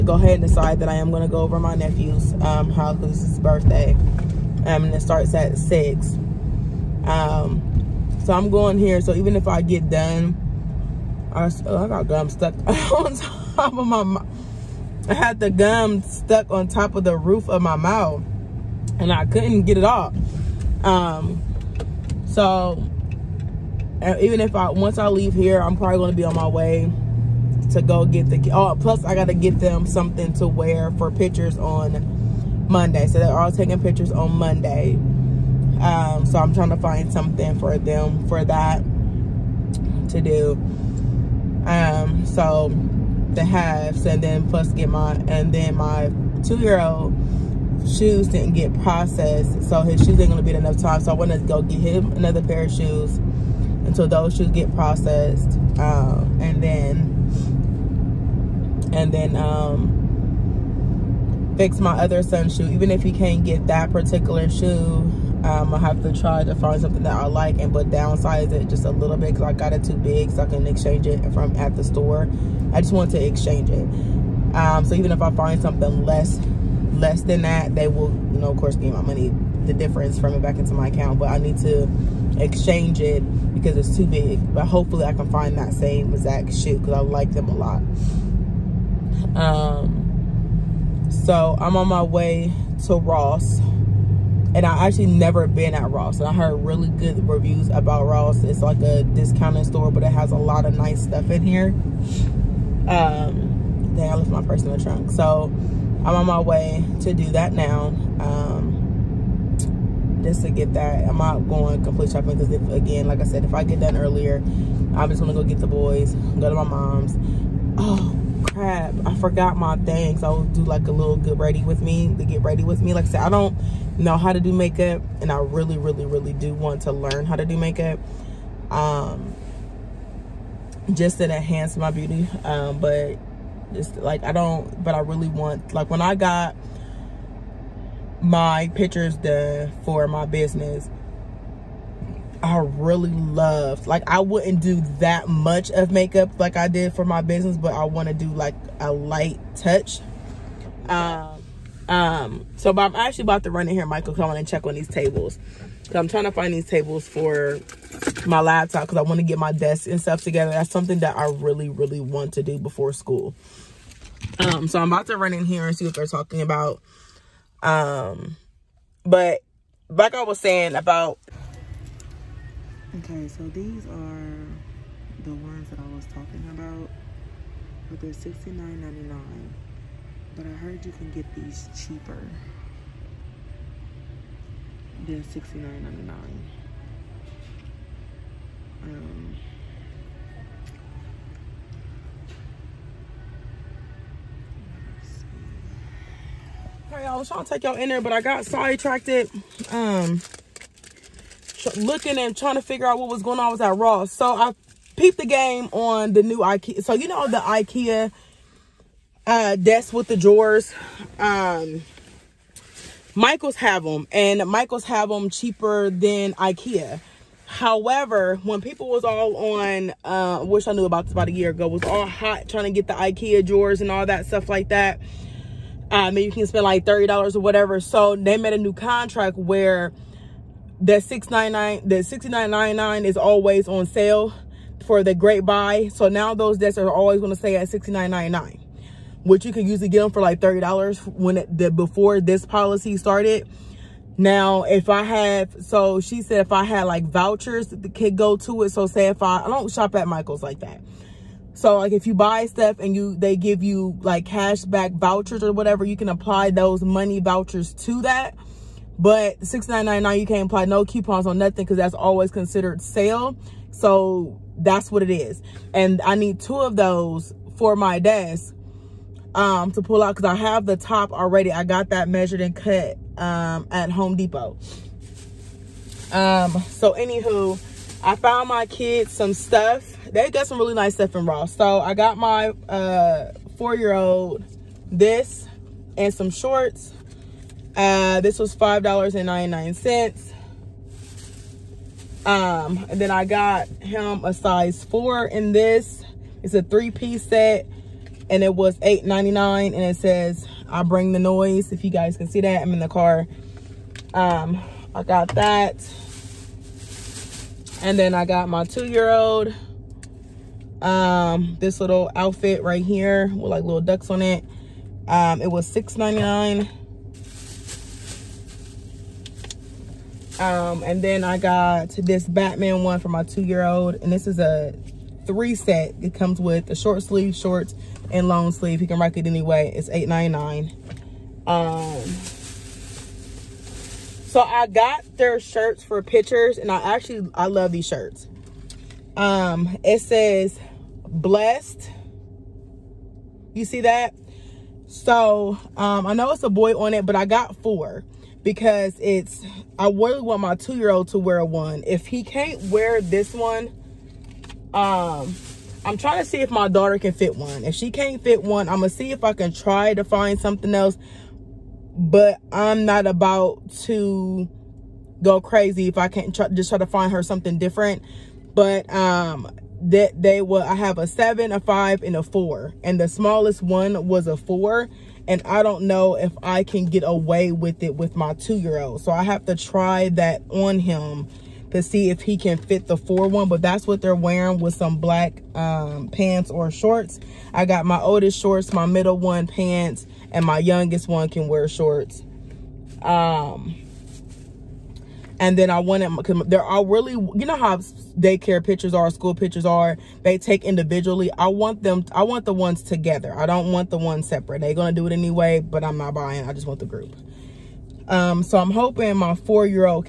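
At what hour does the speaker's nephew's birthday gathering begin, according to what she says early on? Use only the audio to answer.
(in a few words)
6.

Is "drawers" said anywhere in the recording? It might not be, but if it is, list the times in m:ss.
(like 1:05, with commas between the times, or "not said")
3:30, 3:43.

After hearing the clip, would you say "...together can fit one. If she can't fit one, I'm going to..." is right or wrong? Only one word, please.
wrong.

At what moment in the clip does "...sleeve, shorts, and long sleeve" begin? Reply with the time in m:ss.
5:27.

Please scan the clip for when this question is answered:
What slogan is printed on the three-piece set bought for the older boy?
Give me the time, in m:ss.
5:00.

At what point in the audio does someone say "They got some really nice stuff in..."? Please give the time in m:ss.
4:40.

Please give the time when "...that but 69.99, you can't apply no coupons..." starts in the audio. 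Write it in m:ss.
4:18.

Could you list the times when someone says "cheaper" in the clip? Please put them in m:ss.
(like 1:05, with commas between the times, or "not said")
3:01, 3:35.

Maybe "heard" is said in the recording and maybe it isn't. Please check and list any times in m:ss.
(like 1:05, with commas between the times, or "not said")
1:36, 3:00.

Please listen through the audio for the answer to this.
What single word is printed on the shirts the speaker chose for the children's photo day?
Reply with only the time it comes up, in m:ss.
5:41.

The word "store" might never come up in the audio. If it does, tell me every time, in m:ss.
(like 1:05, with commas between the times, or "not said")
1:11, 1:39.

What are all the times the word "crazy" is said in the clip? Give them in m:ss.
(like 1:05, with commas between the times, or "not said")
6:05.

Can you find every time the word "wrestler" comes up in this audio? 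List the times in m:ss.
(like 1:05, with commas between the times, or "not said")
not said.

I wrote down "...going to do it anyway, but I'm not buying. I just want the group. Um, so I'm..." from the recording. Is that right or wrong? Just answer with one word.
right.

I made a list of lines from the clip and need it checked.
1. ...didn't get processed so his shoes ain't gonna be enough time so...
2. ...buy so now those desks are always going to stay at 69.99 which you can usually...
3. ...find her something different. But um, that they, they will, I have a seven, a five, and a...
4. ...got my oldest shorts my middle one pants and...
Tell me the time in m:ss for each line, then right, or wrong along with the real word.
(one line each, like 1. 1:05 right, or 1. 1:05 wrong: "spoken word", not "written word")
1. 0:48 right
2. 3:55 right
3. 6:06 right
4. 6:27 right.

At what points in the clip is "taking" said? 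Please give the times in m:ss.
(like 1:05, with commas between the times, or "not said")
0:33.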